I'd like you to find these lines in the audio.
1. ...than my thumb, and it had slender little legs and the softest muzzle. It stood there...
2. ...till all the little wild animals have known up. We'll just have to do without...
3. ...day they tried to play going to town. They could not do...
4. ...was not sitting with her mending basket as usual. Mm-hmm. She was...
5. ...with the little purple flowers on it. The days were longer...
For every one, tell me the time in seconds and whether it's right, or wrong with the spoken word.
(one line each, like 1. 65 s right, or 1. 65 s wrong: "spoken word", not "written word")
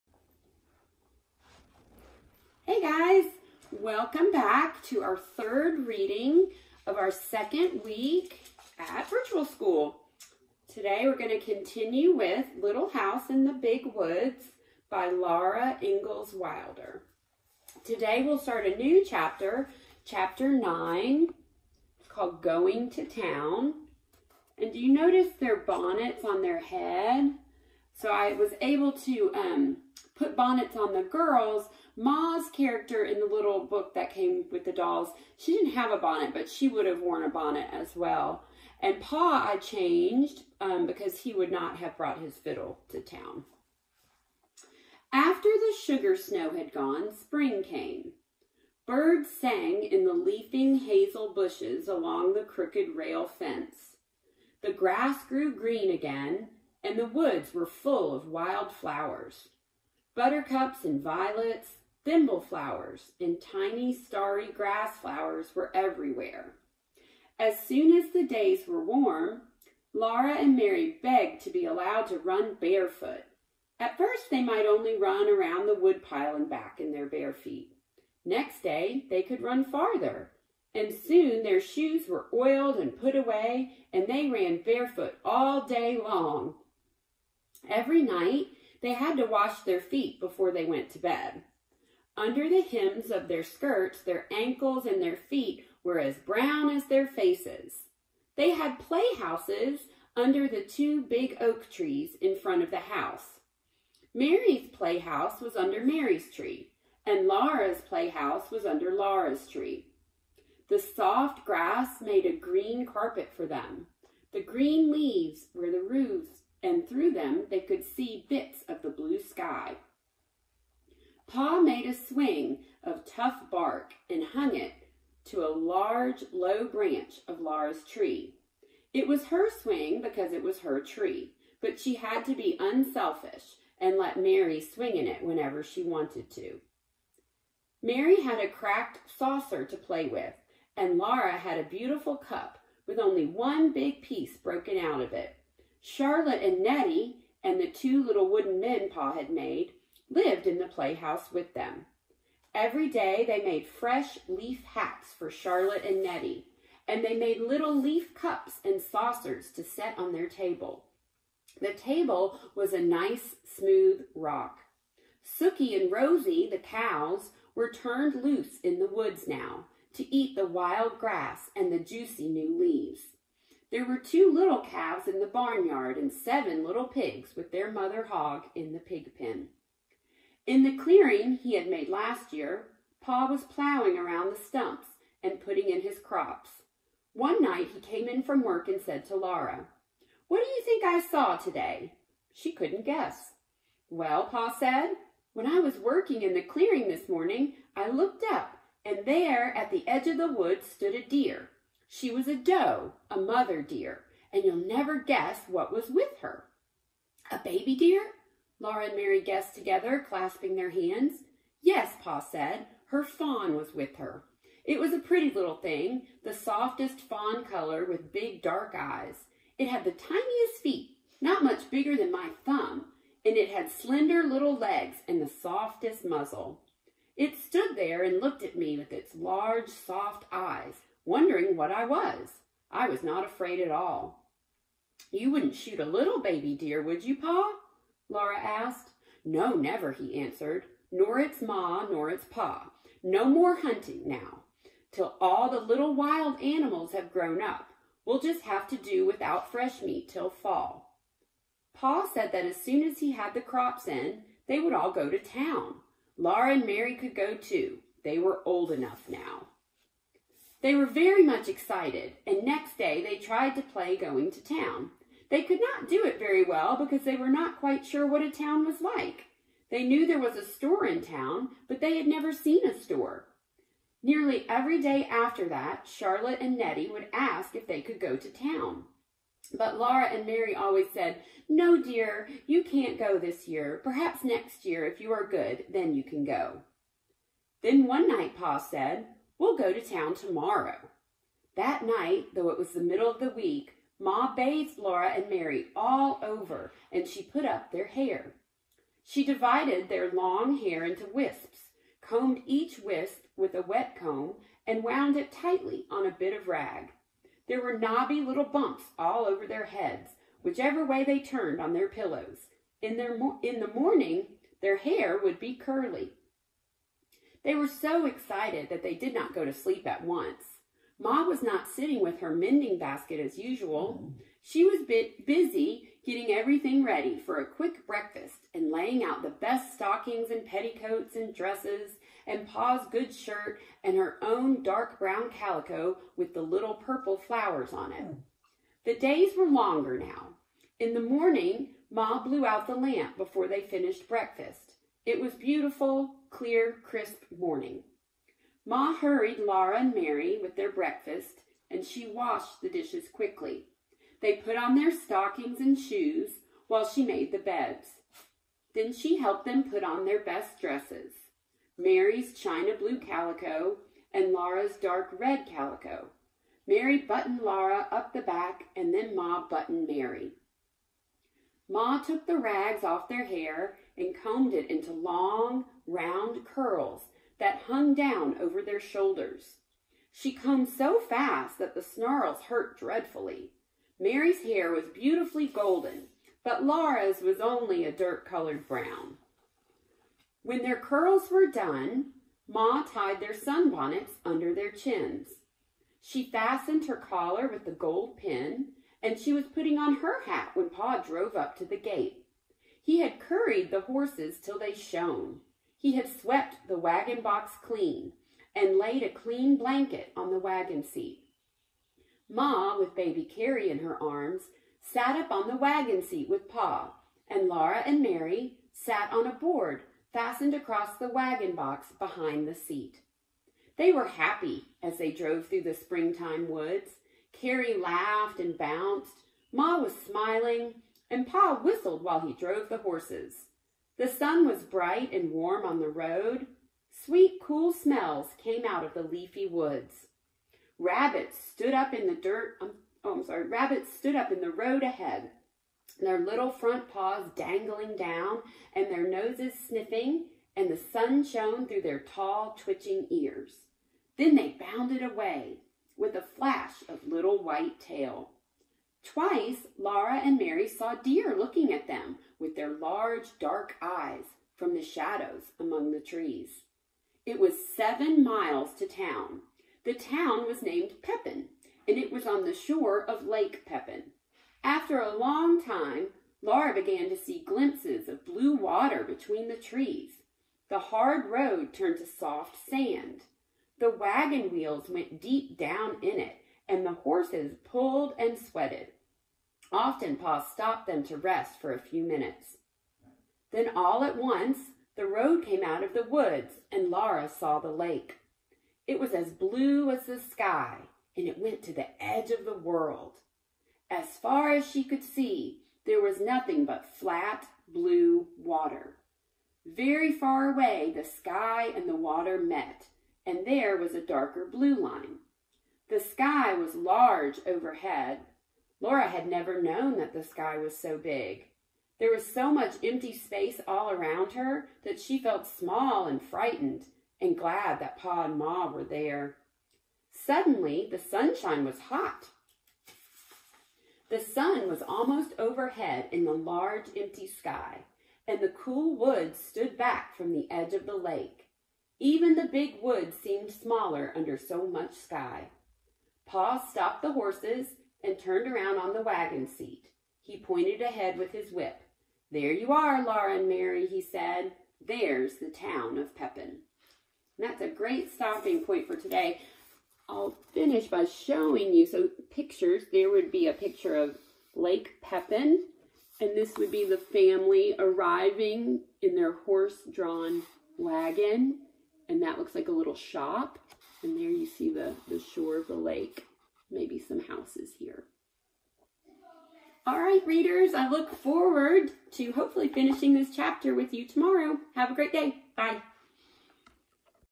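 1. 221 s right
2. 244 s wrong: "grown", not "known"
3. 262 s right
4. 321 s right
5. 336 s right.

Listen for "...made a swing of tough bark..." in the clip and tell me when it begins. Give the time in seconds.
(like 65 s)
121 s.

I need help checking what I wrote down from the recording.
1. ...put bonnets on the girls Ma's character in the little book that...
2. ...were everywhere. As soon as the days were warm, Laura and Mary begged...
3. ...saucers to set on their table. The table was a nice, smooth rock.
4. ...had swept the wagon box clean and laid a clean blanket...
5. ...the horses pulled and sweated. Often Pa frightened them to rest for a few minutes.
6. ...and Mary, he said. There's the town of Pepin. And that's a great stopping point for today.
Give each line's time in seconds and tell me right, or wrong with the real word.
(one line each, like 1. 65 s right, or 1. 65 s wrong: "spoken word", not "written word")
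1. 30 s right
2. 65 s right
3. 158 s right
4. 405 s right
5. 486 s wrong: "stopped", not "frightened"
6. 553 s right.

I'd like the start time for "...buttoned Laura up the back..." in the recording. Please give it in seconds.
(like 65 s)
366 s.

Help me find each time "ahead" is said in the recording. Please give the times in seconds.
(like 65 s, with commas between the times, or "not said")
444 s, 550 s.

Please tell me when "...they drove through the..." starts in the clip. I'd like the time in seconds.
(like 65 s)
424 s.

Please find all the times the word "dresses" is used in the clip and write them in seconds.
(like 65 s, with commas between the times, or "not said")
331 s, 360 s.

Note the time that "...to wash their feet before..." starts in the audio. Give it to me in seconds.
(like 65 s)
89 s.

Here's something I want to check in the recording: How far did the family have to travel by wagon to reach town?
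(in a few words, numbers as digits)
7 miles.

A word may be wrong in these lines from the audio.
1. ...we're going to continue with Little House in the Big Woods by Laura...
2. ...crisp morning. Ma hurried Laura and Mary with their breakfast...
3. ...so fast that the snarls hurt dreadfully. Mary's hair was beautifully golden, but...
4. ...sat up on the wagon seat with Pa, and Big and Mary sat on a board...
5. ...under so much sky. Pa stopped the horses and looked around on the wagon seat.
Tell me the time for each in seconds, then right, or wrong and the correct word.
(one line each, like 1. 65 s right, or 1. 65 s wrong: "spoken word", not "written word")
1. 11 s right
2. 346 s right
3. 380 s right
4. 414 s wrong: "Laura", not "Big"
5. 544 s wrong: "turned", not "looked".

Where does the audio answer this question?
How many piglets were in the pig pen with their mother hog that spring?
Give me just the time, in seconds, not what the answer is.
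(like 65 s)
176 s.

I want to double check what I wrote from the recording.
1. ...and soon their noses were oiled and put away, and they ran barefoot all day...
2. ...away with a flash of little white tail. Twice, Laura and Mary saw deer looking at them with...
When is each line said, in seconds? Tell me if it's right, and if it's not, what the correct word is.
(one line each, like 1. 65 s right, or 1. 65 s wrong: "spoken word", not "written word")
1. 80 s wrong: "shoes", not "noses"
2. 455 s right.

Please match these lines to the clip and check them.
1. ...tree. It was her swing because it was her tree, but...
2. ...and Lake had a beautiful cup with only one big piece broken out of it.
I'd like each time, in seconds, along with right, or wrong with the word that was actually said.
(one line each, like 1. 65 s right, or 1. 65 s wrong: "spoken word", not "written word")
1. 127 s right
2. 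140 s wrong: "Laura", not "Lake".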